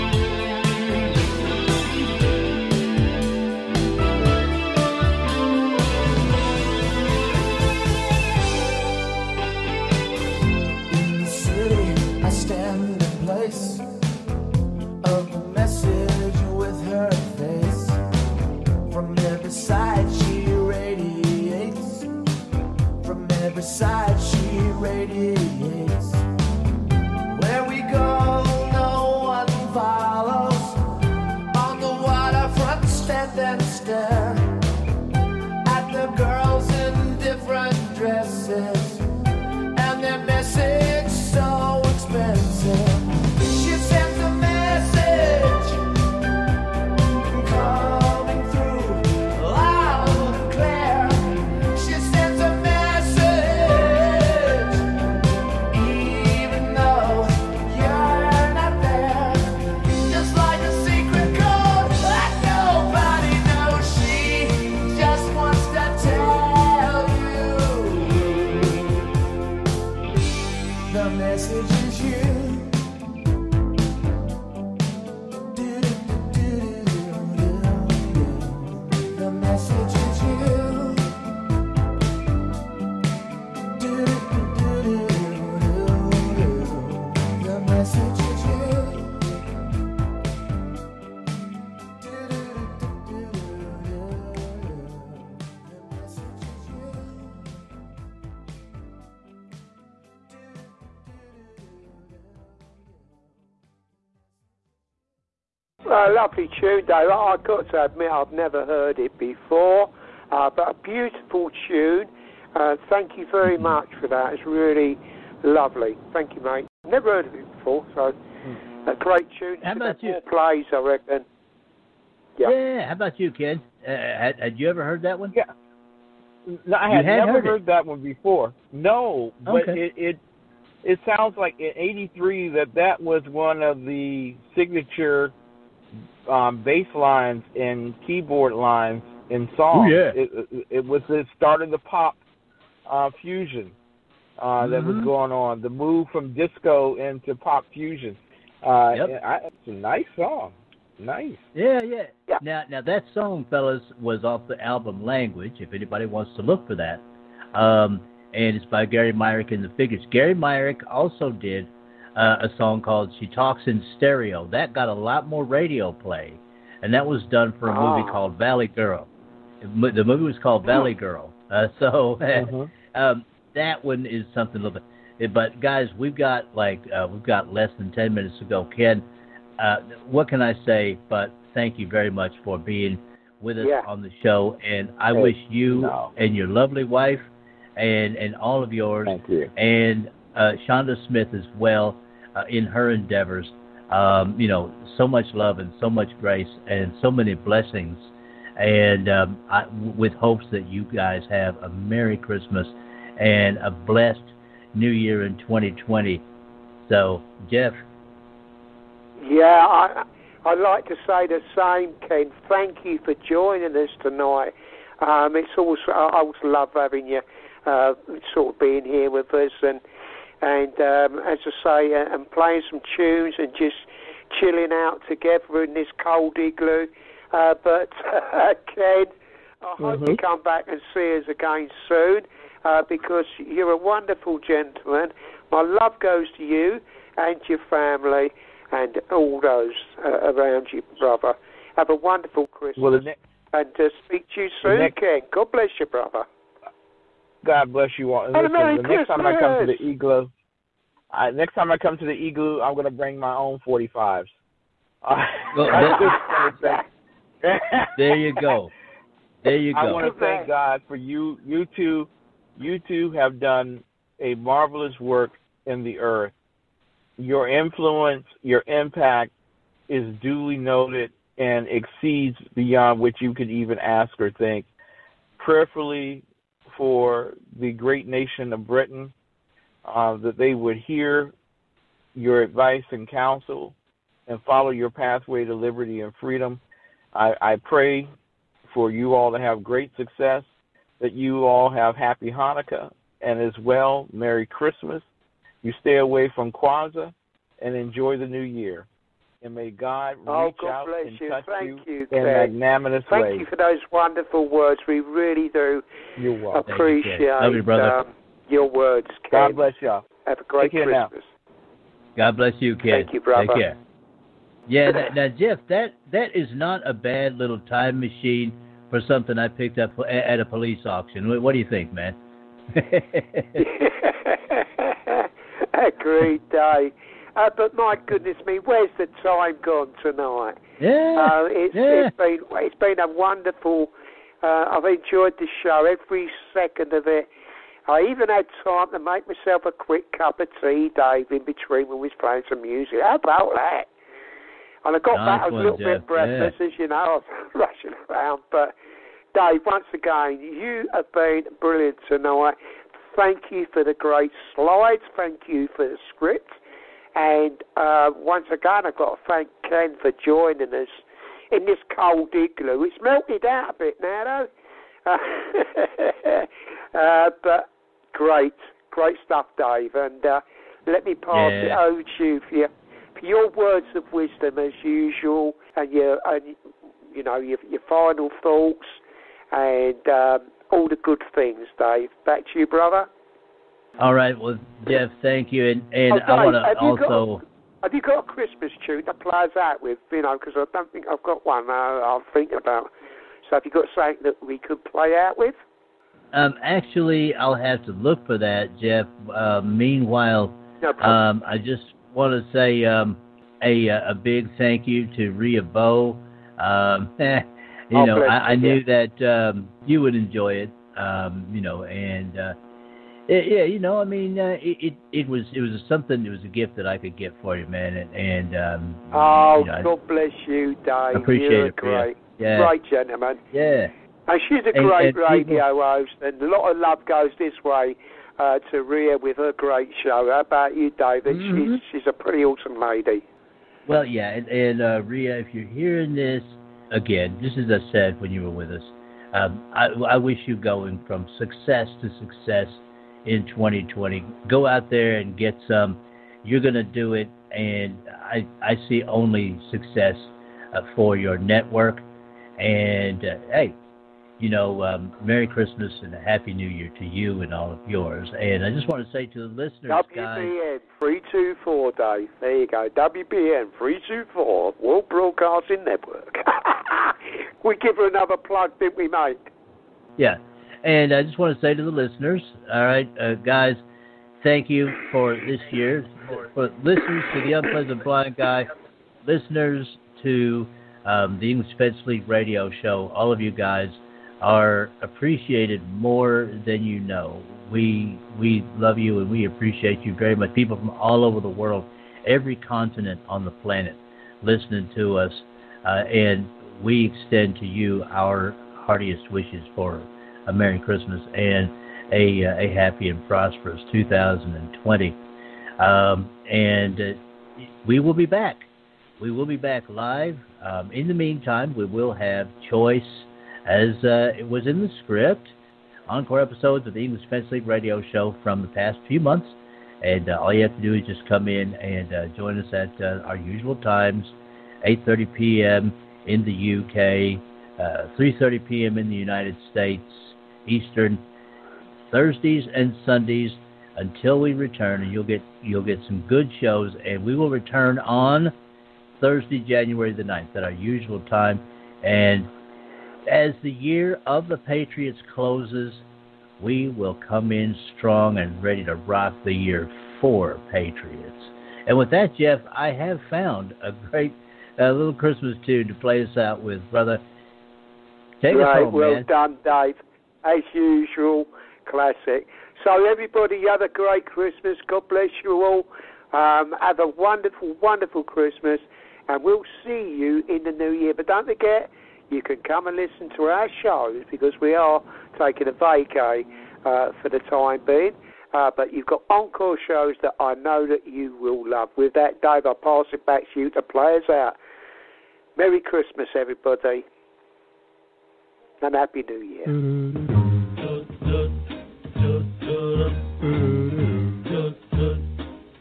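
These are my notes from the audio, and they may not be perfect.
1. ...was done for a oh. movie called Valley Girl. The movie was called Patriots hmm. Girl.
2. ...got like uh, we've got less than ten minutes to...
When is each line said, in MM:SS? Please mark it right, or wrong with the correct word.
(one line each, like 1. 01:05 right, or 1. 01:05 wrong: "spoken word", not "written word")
1. 02:47 wrong: "Valley", not "Patriots"
2. 02:56 right.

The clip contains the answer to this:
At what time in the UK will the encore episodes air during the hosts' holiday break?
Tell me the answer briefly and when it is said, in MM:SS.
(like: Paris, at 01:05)
8:30 p.m., at 08:44.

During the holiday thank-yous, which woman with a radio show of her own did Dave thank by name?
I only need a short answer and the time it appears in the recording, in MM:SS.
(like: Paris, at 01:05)
Ria Bo, at 06:45.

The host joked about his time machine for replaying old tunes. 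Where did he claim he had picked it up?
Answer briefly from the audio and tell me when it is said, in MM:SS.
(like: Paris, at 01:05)
a police auction, at 05:20.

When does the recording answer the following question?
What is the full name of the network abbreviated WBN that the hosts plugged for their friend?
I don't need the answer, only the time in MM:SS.
07:44.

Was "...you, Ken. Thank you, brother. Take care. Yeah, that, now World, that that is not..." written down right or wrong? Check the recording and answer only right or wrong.
wrong.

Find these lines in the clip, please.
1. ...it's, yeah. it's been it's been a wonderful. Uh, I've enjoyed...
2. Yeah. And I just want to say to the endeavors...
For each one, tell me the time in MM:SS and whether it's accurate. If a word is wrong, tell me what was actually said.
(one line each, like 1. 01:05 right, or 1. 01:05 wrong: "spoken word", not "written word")
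1. 05:31 right
2. 07:50 wrong: "listeners", not "endeavors".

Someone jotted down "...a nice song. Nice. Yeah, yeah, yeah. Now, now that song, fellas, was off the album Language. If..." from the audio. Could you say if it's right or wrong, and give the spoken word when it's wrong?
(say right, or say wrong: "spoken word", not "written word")
right.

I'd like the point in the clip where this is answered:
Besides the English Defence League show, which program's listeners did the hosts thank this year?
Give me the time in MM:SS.
07:57.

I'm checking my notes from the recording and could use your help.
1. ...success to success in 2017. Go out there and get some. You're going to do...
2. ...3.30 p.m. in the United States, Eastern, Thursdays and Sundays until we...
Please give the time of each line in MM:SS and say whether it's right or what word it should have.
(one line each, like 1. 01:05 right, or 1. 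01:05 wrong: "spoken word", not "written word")
1. 07:21 wrong: "2020", not "2017"
2. 08:48 right.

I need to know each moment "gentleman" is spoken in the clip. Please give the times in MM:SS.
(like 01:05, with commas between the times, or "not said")
03:54, 07:02.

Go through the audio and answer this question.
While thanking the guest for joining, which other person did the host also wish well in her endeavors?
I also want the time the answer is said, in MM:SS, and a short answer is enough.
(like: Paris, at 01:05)
Shonda Smith, at 03:10.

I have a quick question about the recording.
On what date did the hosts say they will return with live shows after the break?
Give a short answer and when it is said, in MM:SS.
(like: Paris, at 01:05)
Thursday, January 9, at 08:59.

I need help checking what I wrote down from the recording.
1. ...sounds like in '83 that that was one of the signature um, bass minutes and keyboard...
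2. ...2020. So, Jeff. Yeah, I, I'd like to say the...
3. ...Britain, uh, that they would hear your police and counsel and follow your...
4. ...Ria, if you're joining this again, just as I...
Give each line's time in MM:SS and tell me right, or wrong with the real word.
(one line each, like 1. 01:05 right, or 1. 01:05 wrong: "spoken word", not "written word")
1. 02:11 wrong: "lines", not "minutes"
2. 03:25 right
3. 04:38 wrong: "advice", not "police"
4. 07:15 wrong: "hearing", not "joining".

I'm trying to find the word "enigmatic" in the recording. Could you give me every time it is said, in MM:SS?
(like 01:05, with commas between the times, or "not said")
not said.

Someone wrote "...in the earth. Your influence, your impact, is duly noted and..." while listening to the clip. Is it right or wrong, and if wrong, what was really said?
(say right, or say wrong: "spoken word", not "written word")
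right.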